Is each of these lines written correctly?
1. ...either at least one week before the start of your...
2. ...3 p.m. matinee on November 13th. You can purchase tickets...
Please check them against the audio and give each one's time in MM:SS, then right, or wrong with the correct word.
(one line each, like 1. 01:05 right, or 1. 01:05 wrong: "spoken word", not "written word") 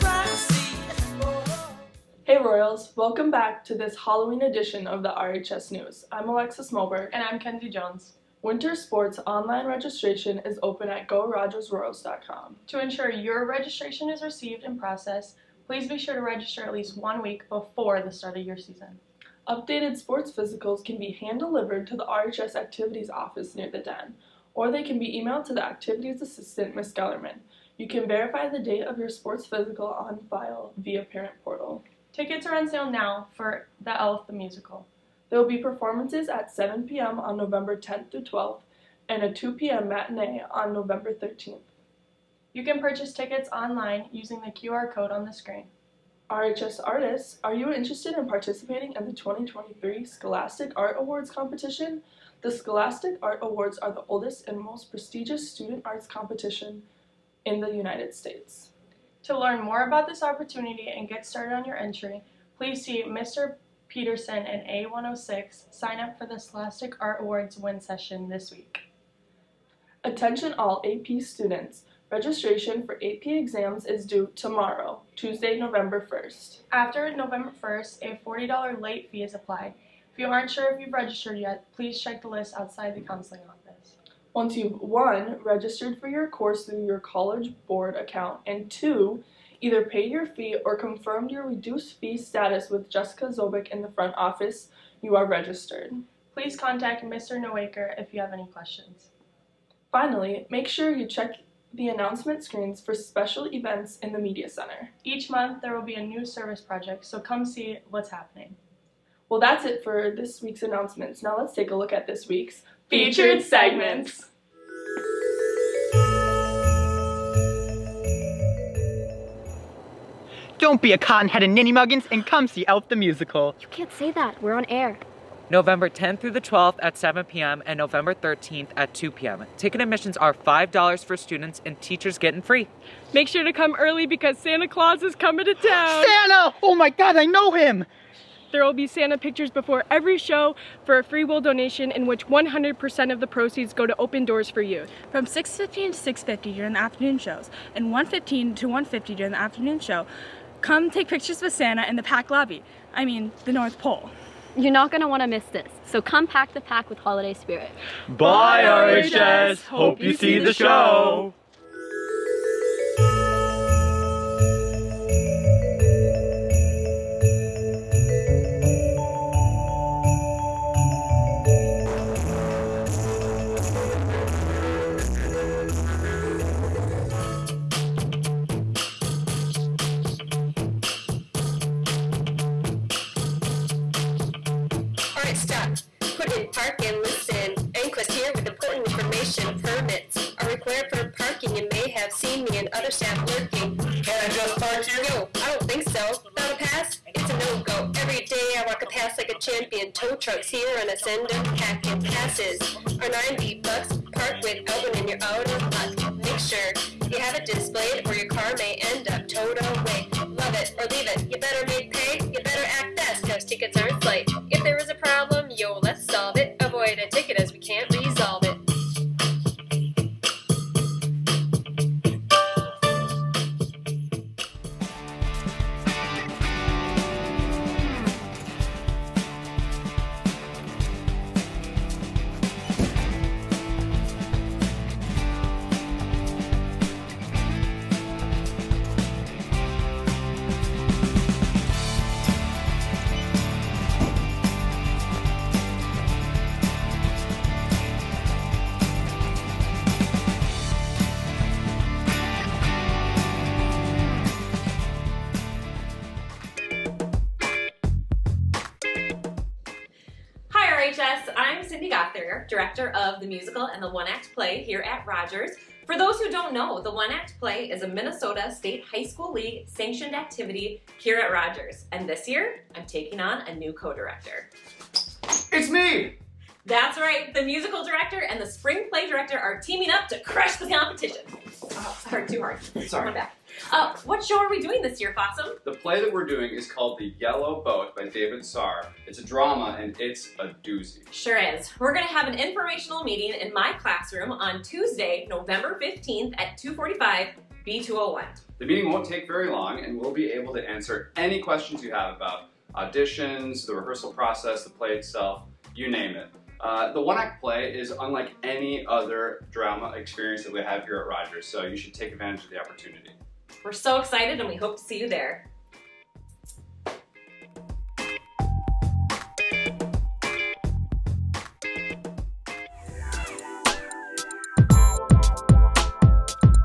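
1. 00:16 wrong: "register", not "either"
2. 00:39 wrong: "2", not "3".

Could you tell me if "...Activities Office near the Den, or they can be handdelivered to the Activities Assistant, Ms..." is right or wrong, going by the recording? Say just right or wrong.
wrong.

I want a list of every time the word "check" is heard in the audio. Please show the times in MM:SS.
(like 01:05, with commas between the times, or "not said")
01:22, 01:41.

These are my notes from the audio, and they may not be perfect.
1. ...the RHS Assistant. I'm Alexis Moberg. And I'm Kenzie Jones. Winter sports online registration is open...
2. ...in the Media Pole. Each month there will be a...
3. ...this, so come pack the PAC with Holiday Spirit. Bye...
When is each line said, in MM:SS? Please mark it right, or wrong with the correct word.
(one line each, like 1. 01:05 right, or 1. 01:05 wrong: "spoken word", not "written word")
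1. 00:05 wrong: "News", not "Assistant"
2. 01:43 wrong: "Center", not "Pole"
3. 02:35 right.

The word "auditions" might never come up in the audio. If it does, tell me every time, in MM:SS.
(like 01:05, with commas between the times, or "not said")
05:02.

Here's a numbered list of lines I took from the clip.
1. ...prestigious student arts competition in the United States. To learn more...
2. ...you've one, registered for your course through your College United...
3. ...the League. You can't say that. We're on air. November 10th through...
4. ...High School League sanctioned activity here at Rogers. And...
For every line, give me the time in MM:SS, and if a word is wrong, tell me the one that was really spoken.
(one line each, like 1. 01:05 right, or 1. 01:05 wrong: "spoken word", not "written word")
1. 00:54 right
2. 01:24 wrong: "Board", not "United"
3. 02:02 wrong: "Musical", not "League"
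4. 04:28 right.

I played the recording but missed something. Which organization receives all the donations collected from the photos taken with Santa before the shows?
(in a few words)
Open Doors for Youth.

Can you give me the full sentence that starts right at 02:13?
Make sure to come early because Santa Claus is coming to town.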